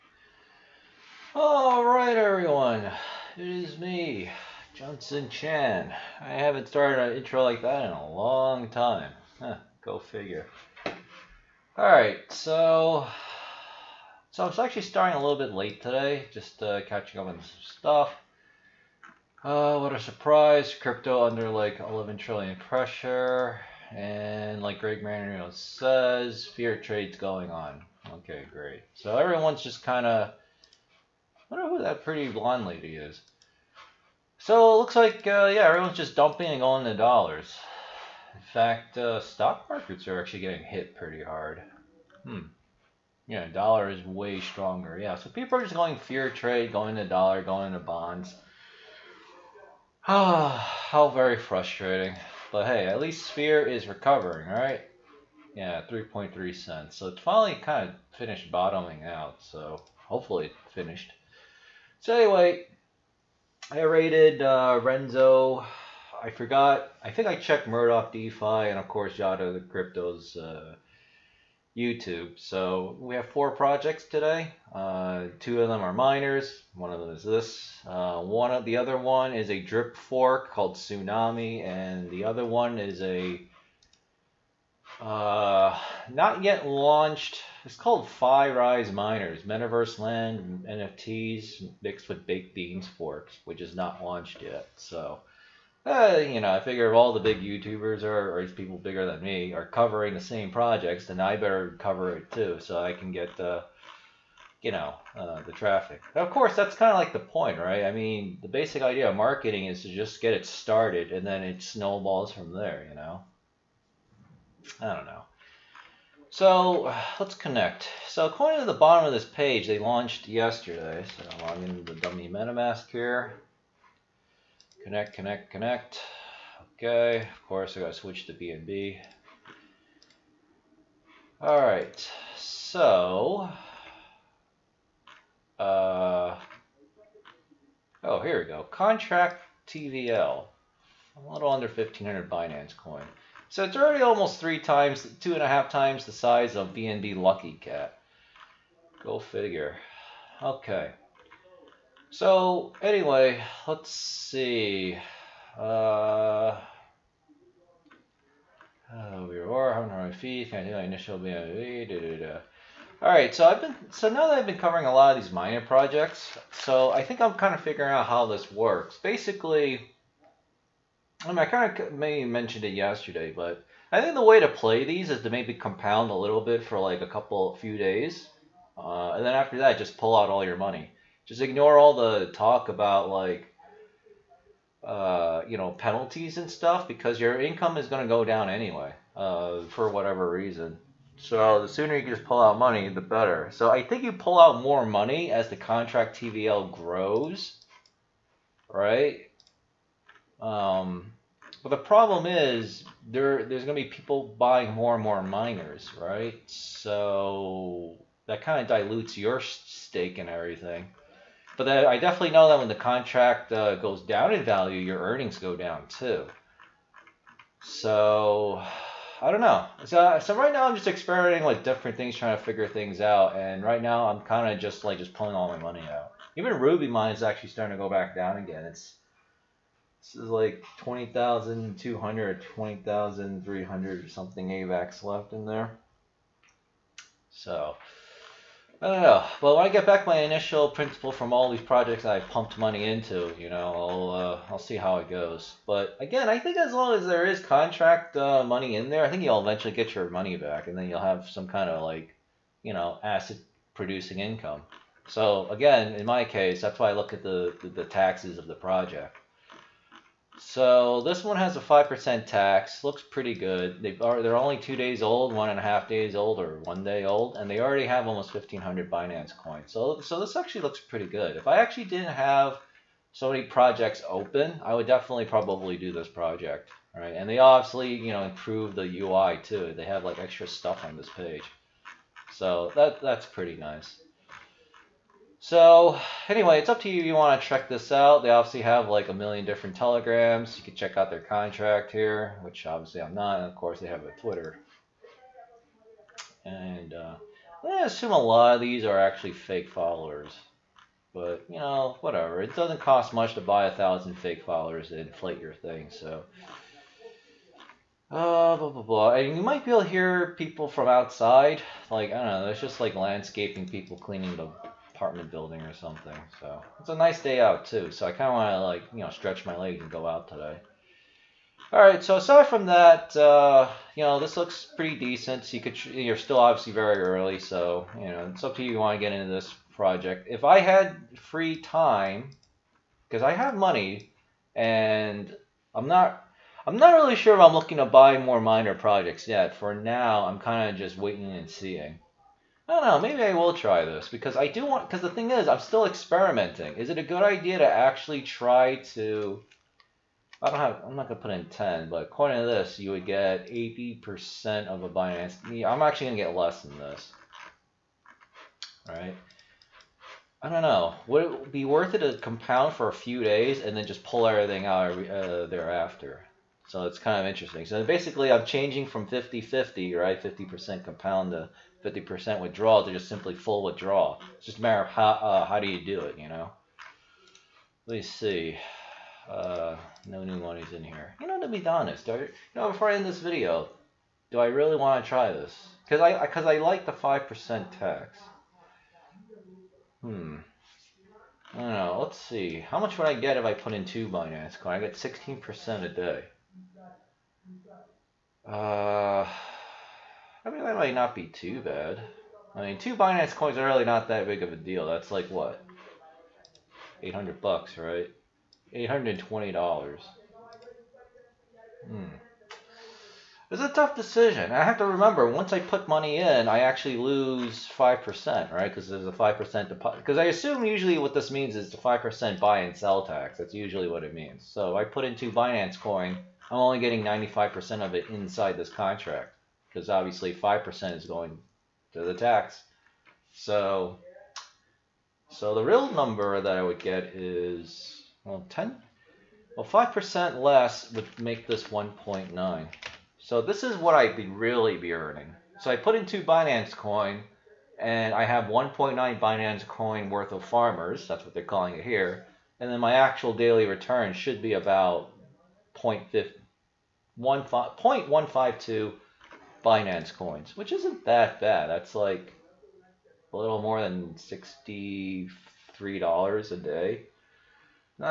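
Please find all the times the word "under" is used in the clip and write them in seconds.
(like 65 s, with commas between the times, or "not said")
21 s, 141 s.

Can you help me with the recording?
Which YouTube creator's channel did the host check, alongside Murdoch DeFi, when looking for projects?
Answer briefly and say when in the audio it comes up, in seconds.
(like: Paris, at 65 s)
Yada the Crypto, at 69 s.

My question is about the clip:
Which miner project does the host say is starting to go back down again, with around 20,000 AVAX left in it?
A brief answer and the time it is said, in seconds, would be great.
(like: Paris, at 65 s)
Ruby mine, at 226 s.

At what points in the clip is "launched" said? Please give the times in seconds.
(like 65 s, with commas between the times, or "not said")
86 s, 94 s, 119 s.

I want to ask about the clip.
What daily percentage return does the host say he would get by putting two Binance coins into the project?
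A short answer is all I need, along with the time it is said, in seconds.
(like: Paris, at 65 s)
16%, at 394 s.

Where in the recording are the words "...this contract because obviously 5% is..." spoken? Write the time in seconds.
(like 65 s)
428 s.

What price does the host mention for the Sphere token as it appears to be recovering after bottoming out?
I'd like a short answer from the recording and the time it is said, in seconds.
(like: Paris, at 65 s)
3.3 cents, at 55 s.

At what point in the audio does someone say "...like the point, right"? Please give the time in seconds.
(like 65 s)
106 s.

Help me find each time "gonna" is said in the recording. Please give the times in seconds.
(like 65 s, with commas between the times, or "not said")
351 s, 356 s.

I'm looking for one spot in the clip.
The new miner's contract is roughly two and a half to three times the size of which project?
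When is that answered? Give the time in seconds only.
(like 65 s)
146 s.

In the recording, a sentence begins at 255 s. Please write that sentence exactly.
So again, in my case, that's why I look at the, the, the taxes of the project.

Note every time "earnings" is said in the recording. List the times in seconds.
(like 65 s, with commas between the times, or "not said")
214 s, 444 s.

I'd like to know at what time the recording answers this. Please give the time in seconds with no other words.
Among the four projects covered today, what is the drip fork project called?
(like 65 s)
80 s.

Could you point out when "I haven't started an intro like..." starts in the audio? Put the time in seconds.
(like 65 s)
6 s.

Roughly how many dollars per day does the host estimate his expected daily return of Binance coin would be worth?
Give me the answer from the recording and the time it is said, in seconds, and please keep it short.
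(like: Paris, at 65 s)
$63, at 464 s.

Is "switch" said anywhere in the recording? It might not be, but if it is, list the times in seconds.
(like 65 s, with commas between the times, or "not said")
127 s.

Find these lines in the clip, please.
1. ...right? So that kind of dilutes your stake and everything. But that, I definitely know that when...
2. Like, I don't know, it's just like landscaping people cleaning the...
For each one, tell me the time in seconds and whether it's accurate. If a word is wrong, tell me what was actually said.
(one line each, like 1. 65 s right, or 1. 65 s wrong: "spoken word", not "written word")
1. 206 s right
2. 311 s right.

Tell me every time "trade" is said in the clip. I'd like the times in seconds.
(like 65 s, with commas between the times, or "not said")
26 s, 46 s.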